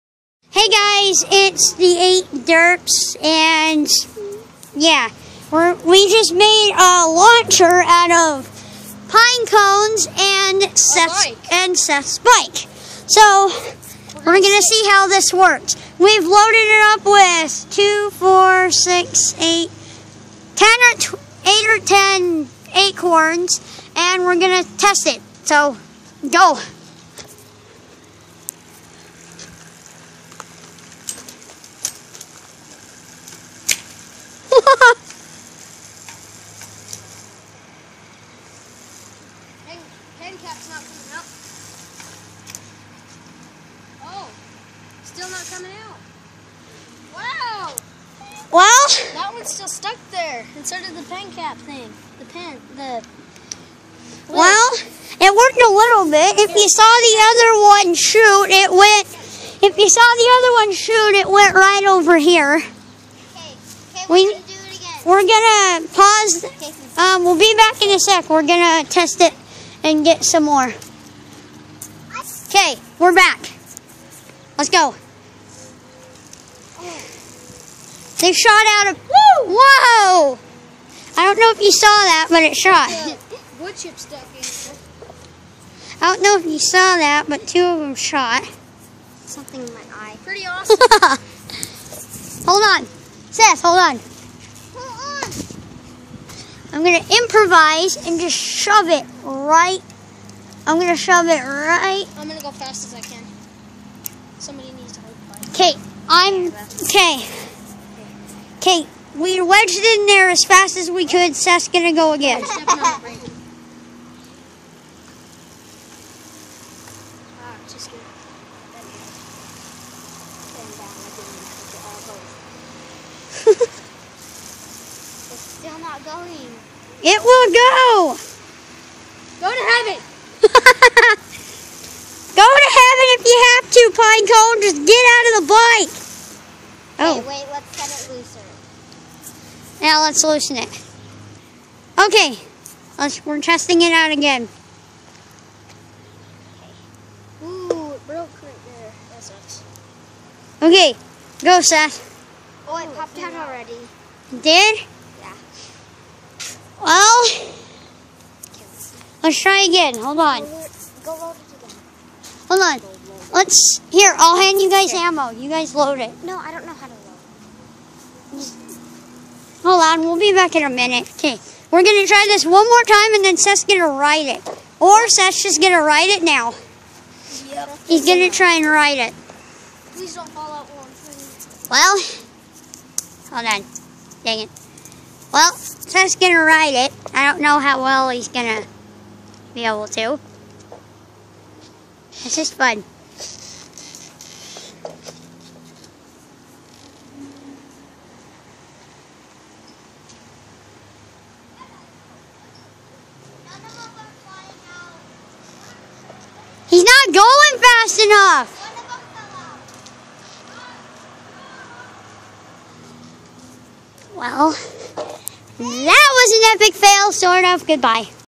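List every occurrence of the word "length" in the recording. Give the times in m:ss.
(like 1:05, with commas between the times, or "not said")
not said.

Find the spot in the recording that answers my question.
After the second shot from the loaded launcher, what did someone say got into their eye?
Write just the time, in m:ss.
1:29.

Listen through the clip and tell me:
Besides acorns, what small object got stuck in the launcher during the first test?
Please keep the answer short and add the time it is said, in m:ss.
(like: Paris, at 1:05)
pen cap, at 0:51.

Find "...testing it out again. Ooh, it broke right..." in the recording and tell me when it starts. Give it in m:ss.
2:23.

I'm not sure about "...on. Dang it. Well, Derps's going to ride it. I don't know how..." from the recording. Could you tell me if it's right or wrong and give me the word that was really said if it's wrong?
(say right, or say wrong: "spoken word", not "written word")
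wrong: "Seth", not "Derps".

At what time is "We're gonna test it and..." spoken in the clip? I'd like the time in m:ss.
1:08.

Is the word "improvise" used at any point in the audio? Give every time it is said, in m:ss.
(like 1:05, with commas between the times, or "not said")
1:37.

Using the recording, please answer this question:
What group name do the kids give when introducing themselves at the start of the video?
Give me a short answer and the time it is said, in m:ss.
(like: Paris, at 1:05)
the 8 Derps, at 0:01.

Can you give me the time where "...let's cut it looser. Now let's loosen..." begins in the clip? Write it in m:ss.
2:17.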